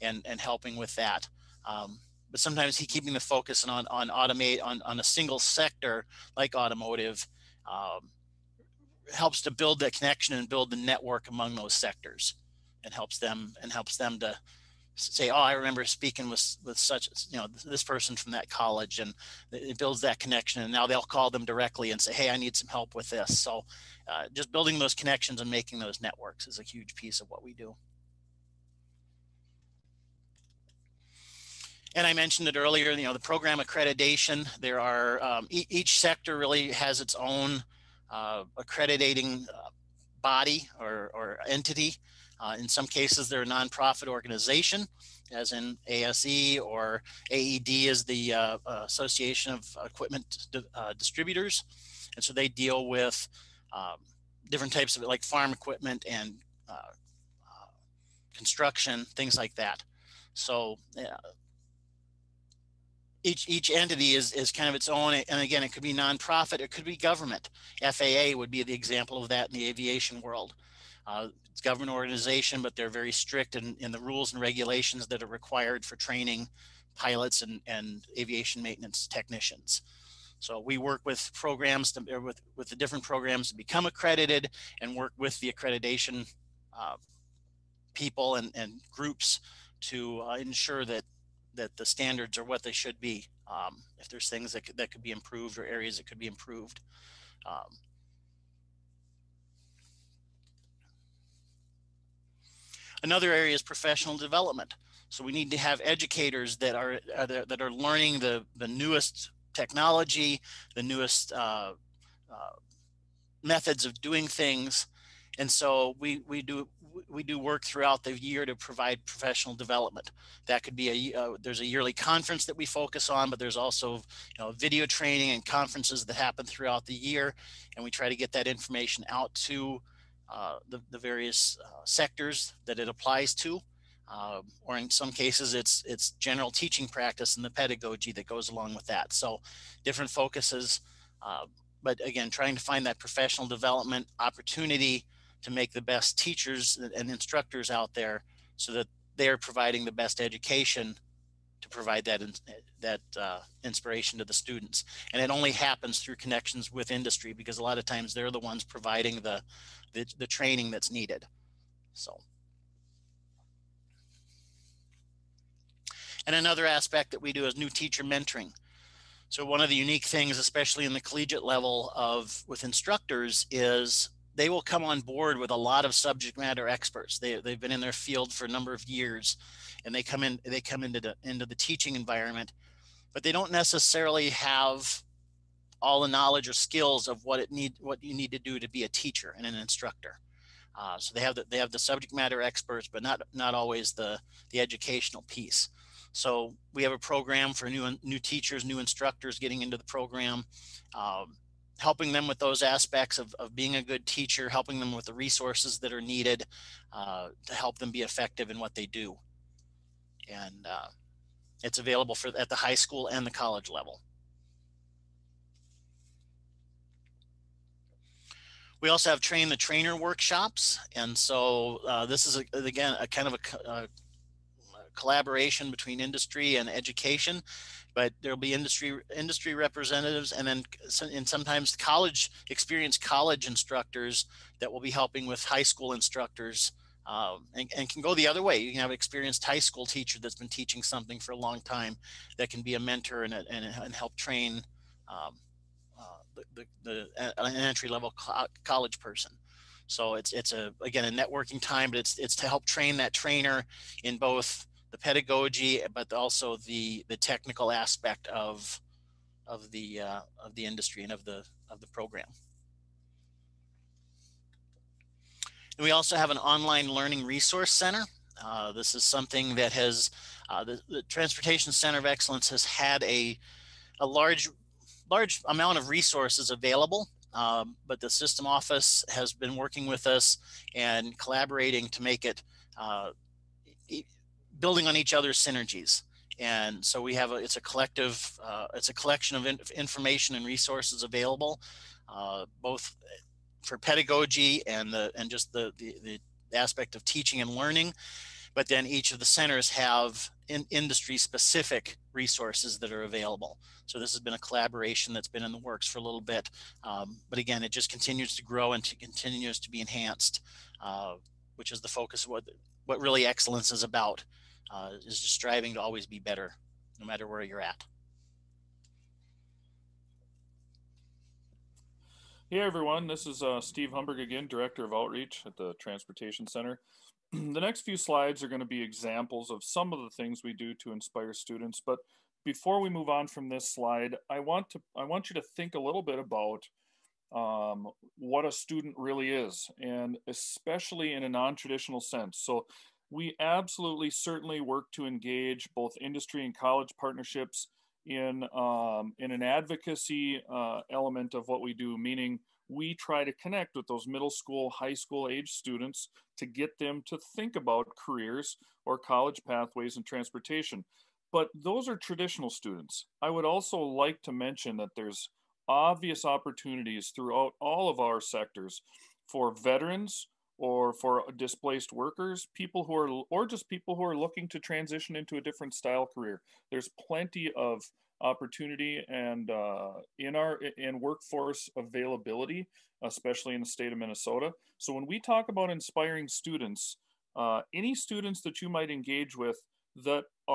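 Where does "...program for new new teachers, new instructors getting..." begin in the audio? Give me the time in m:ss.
3:16.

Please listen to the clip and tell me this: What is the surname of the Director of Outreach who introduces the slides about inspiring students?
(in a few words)
Humberg.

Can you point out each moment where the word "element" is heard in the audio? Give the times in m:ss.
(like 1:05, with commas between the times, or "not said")
5:50.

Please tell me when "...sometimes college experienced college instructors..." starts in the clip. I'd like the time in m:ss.
3:51.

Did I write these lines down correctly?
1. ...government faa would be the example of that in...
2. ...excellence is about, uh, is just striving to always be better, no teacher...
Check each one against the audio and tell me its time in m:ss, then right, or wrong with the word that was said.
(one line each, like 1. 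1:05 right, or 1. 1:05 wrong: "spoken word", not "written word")
1. 1:06 right
2. 5:13 wrong: "matter", not "teacher".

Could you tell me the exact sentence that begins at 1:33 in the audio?
Um, if there's things that could, that could be improved or areas that could be improved.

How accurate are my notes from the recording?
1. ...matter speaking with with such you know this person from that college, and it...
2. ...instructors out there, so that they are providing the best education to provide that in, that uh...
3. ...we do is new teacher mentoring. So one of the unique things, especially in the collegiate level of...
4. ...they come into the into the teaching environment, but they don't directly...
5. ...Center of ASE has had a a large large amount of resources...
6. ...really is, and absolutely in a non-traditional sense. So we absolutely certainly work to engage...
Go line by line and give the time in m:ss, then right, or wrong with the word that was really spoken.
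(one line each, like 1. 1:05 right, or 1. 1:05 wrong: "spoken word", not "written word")
1. 0:15 wrong: "remember", not "matter"
2. 2:27 right
3. 2:47 right
4. 3:00 wrong: "necessarily", not "directly"
5. 4:31 wrong: "Excellence", not "ASE"
6. 5:38 wrong: "especially", not "absolutely".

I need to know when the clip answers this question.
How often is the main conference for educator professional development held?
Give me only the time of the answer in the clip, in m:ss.
2:01.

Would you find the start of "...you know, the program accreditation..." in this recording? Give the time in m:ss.
0:32.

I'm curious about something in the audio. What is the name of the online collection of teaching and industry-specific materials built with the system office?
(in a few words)
Online learning resource center.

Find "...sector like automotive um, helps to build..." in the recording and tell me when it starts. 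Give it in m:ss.
0:05.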